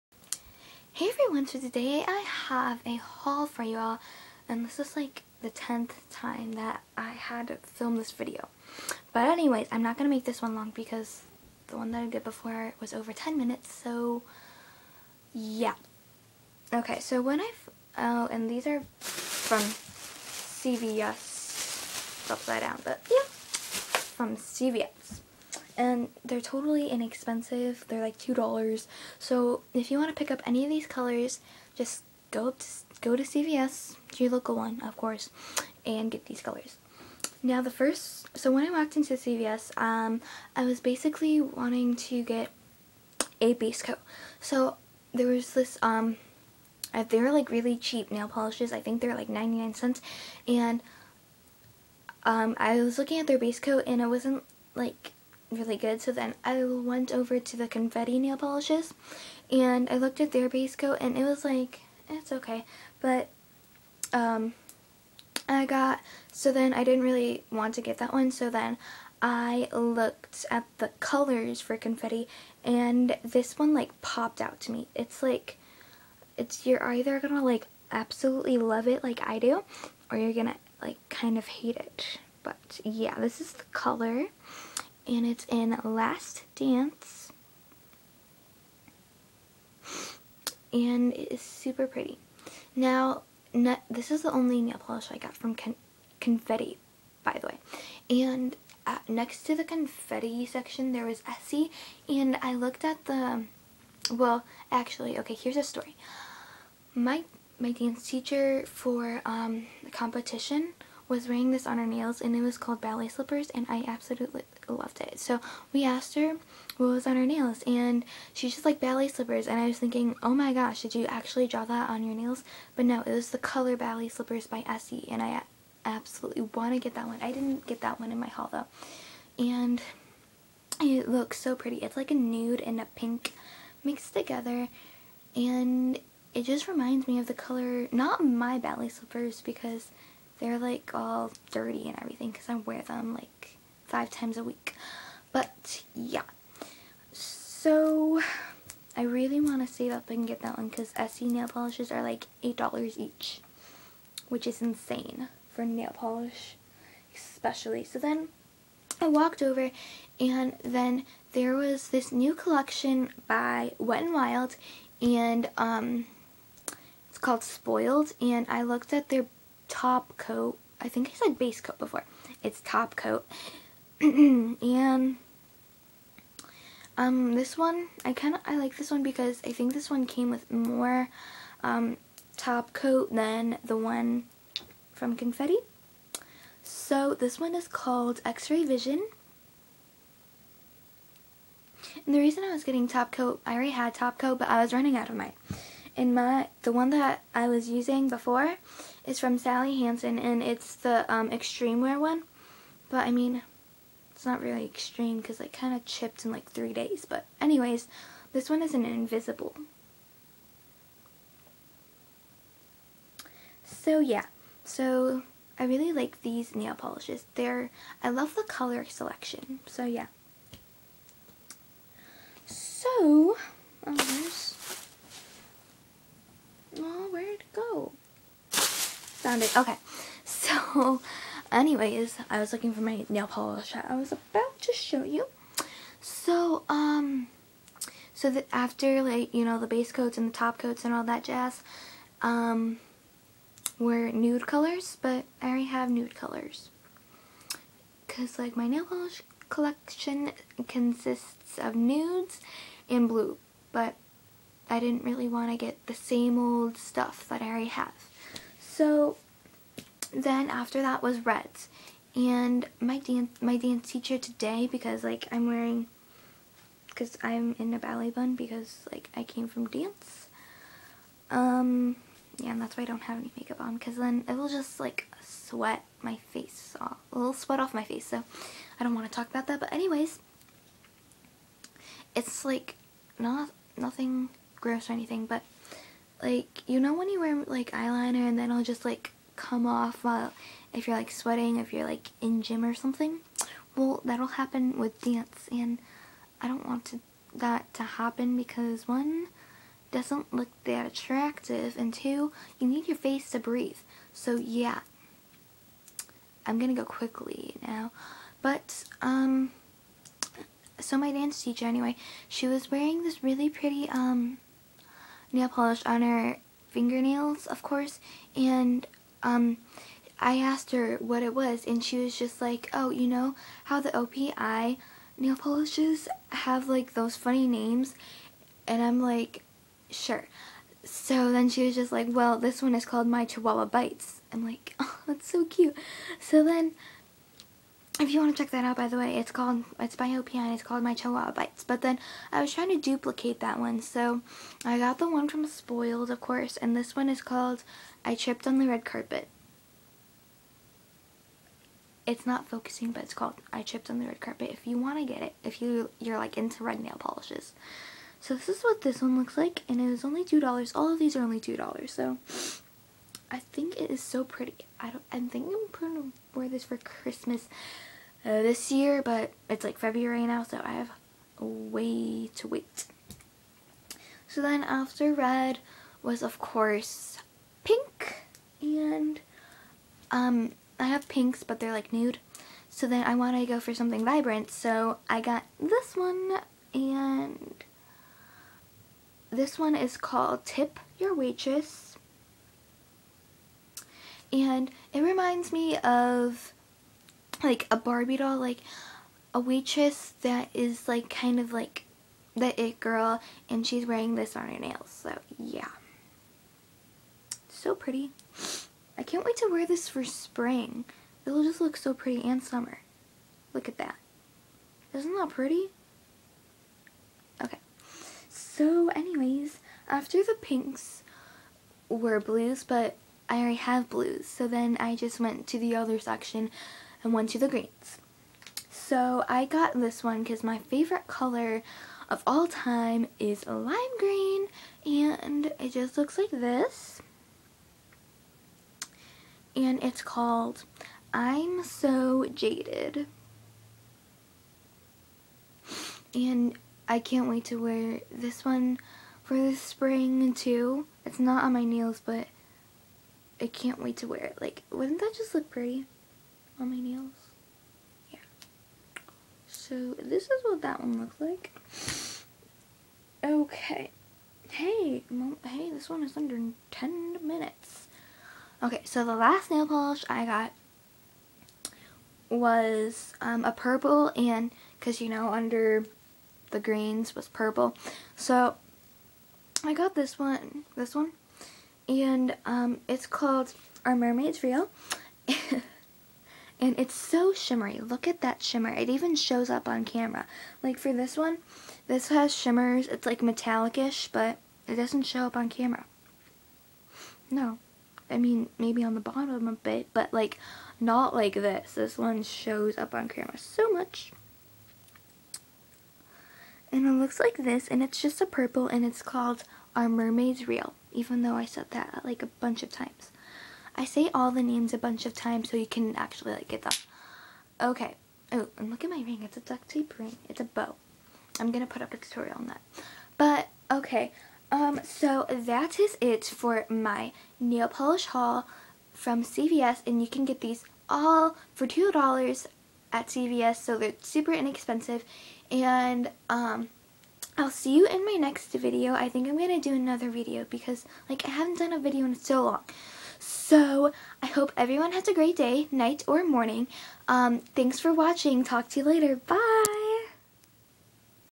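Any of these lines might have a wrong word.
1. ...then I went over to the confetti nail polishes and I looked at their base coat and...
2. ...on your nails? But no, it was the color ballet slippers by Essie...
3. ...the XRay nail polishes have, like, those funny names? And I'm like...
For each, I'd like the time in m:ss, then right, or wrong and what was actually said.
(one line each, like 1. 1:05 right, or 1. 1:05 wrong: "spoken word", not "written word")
1. 0:56 right
2. 2:01 right
3. 5:23 wrong: "OPI", not "XRay".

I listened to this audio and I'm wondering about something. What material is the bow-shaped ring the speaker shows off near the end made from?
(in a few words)
Duct tape.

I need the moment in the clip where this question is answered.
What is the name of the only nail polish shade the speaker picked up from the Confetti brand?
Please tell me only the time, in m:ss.
1:25.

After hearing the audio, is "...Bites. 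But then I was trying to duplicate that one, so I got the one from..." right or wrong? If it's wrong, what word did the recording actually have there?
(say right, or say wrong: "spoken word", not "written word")
right.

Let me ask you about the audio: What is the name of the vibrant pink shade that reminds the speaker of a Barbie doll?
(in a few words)
Tip Your Waitress.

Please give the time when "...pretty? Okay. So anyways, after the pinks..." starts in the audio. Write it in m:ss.
6:55.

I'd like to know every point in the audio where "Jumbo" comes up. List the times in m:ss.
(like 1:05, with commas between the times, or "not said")
not said.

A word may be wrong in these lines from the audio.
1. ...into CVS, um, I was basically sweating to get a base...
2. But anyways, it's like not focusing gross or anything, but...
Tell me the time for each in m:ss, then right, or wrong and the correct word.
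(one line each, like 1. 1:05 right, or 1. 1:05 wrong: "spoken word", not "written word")
1. 0:38 wrong: "wanting", not "sweating"
2. 4:39 wrong: "nothing", not "focusing".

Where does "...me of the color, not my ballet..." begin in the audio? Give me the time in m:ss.
2:17.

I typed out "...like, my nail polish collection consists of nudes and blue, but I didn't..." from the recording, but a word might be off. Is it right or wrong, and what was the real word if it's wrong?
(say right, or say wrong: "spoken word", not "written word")
right.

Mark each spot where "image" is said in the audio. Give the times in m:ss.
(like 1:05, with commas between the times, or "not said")
not said.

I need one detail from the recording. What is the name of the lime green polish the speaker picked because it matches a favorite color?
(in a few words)
I'm So Jaded.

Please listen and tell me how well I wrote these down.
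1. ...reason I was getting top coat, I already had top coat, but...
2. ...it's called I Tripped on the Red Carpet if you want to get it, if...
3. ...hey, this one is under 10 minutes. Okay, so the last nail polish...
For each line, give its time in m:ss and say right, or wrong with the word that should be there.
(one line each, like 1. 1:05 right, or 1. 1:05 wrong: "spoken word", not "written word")
1. 3:12 right
2. 5:53 right
3. 7:45 right.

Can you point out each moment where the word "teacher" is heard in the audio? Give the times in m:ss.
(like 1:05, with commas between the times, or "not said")
1:48, 4:23, 5:11.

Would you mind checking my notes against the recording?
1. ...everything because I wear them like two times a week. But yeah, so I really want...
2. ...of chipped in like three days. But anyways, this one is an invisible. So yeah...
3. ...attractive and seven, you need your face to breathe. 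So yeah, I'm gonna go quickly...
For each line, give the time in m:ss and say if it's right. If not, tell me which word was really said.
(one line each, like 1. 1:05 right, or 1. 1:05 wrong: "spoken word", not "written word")
1. 2:22 wrong: "five", not "two"
2. 3:25 right
3. 5:00 wrong: "two", not "seven".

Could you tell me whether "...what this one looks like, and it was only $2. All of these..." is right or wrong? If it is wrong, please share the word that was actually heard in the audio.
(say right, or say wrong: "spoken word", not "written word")
right.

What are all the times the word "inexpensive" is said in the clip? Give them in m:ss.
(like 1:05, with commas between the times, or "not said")
0:26, 8:54.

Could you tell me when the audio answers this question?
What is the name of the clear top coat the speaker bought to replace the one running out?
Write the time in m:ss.
3:08.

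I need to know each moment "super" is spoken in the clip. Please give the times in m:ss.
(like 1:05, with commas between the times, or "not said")
1:31, 8:54.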